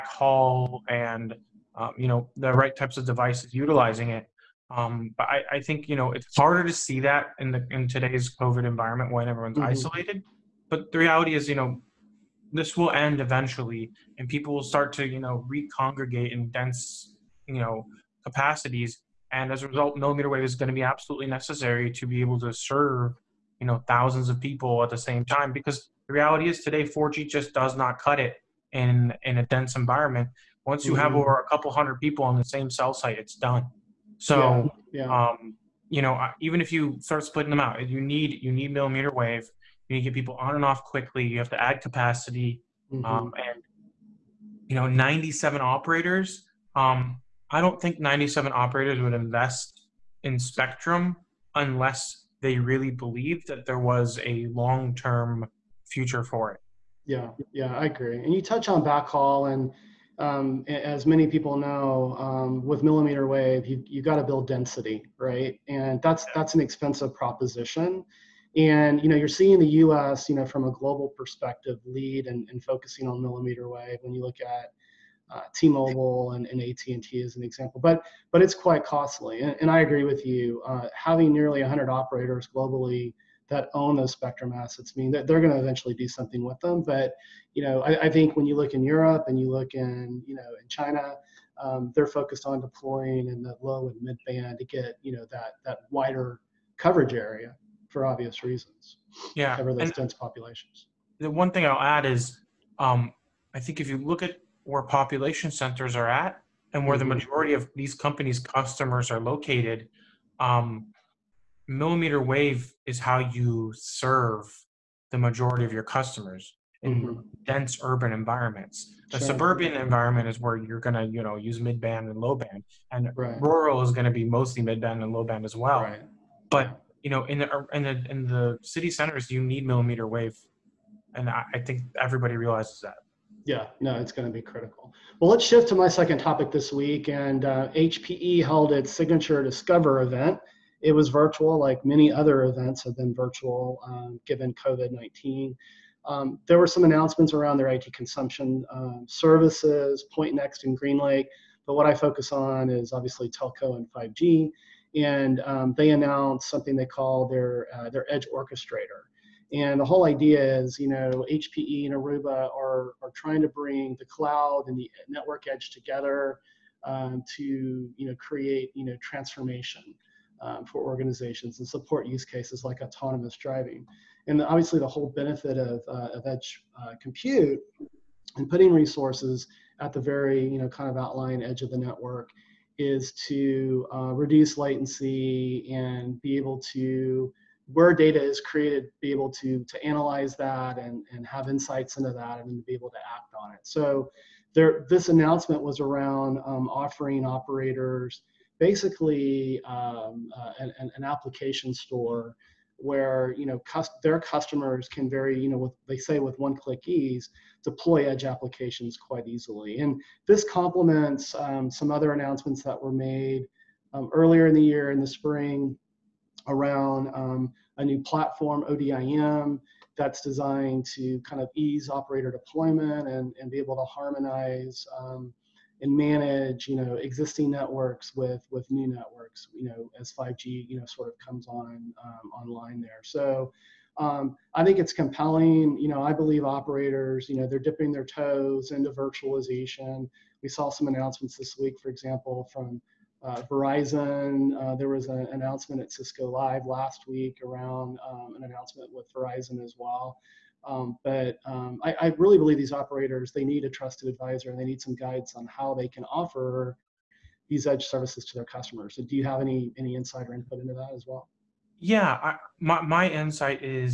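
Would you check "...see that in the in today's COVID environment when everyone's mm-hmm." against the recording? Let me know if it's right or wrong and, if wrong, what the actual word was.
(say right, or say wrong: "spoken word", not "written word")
right.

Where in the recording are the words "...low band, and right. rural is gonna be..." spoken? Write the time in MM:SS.
02:02.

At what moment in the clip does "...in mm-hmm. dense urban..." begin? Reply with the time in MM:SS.
01:56.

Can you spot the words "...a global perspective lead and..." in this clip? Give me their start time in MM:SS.
01:10.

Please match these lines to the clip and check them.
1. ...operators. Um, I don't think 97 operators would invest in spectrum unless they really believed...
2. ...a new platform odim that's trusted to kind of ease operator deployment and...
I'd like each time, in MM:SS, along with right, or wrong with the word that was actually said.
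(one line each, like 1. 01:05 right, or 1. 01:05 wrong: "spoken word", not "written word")
1. 00:45 right
2. 03:37 wrong: "designed", not "trusted".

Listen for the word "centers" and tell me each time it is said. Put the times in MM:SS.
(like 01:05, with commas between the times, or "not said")
01:45, 02:08.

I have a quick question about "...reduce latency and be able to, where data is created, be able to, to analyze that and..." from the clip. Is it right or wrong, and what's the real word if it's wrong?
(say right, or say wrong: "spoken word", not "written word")
right.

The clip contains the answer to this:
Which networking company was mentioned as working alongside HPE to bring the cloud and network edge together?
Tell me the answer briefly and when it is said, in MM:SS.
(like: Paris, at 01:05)
Aruba, at 02:41.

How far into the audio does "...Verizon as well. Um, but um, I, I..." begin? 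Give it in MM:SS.
04:09.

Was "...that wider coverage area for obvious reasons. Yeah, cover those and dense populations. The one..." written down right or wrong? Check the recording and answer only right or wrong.
right.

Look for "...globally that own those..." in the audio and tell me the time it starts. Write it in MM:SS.
01:22.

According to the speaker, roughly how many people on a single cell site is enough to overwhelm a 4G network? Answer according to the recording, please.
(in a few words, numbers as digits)
a couple hundred.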